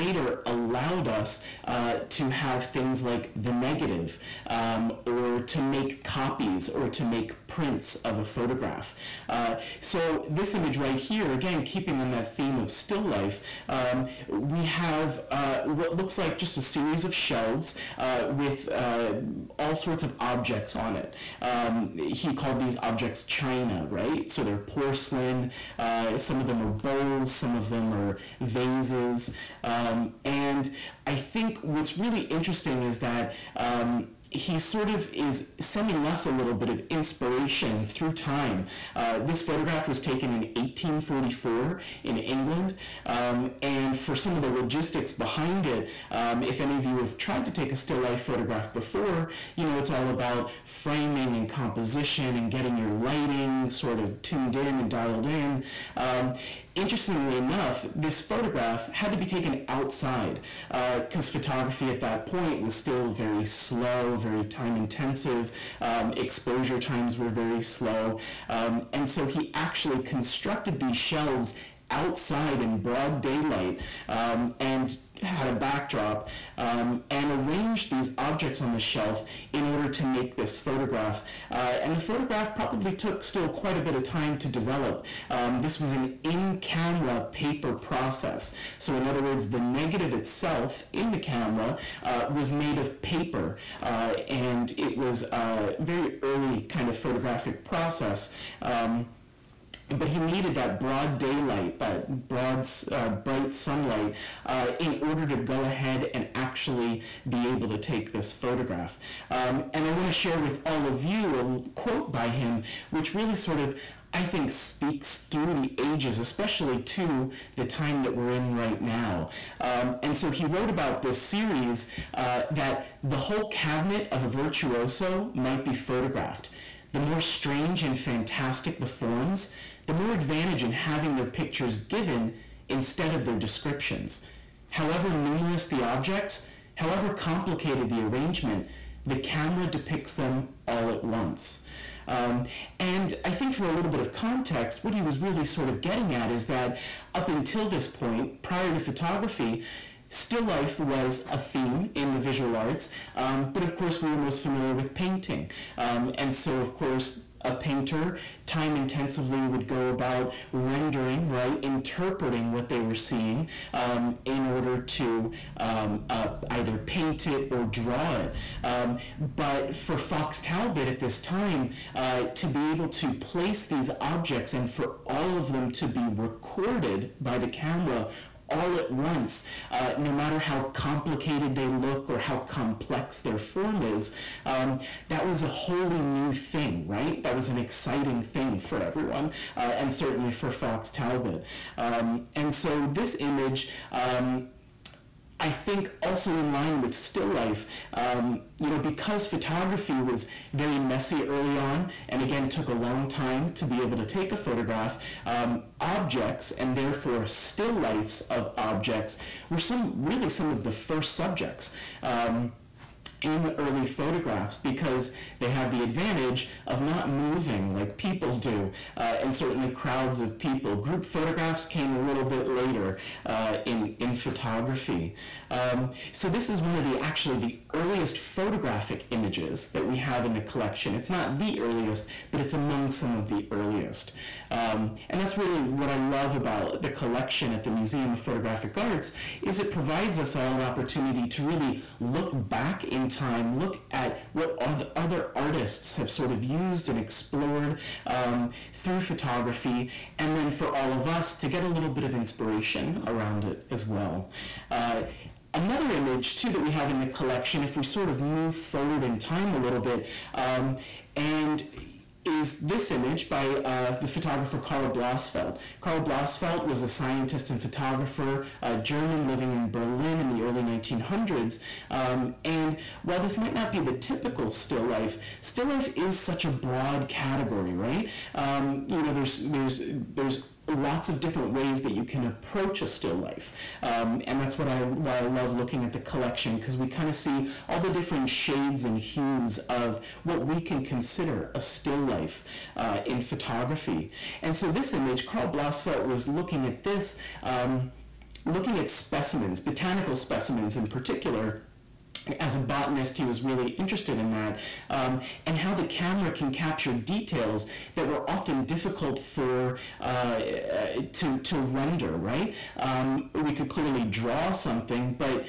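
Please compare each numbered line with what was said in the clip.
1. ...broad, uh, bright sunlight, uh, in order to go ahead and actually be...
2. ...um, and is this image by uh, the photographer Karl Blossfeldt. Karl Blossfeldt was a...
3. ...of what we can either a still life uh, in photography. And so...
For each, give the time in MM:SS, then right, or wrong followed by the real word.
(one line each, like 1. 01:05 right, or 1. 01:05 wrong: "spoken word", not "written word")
1. 01:42 right
2. 04:20 right
3. 04:49 wrong: "consider", not "either".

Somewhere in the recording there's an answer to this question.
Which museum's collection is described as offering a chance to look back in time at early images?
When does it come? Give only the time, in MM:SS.
03:57.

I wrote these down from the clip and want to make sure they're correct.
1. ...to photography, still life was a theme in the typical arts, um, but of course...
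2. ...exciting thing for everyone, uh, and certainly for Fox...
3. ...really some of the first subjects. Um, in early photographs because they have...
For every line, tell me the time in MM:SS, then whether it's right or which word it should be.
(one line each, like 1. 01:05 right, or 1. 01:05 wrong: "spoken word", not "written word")
1. 02:28 wrong: "visual", not "typical"
2. 03:07 right
3. 03:30 right.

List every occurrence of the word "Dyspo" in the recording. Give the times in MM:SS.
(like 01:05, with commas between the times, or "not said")
not said.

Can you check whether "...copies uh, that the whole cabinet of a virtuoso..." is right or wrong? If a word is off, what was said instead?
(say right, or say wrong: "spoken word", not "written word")
wrong: "series", not "copies".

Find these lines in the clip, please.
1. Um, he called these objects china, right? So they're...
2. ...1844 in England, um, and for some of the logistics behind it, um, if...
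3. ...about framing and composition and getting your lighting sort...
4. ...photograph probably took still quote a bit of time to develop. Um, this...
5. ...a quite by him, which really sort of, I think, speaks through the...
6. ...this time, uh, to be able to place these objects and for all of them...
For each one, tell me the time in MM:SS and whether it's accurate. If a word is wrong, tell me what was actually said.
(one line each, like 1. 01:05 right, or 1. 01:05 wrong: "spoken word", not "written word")
1. 00:21 right
2. 00:40 right
3. 00:50 right
4. 01:21 wrong: "quite", not "quote"
5. 01:51 wrong: "quote", not "quite"
6. 02:50 right.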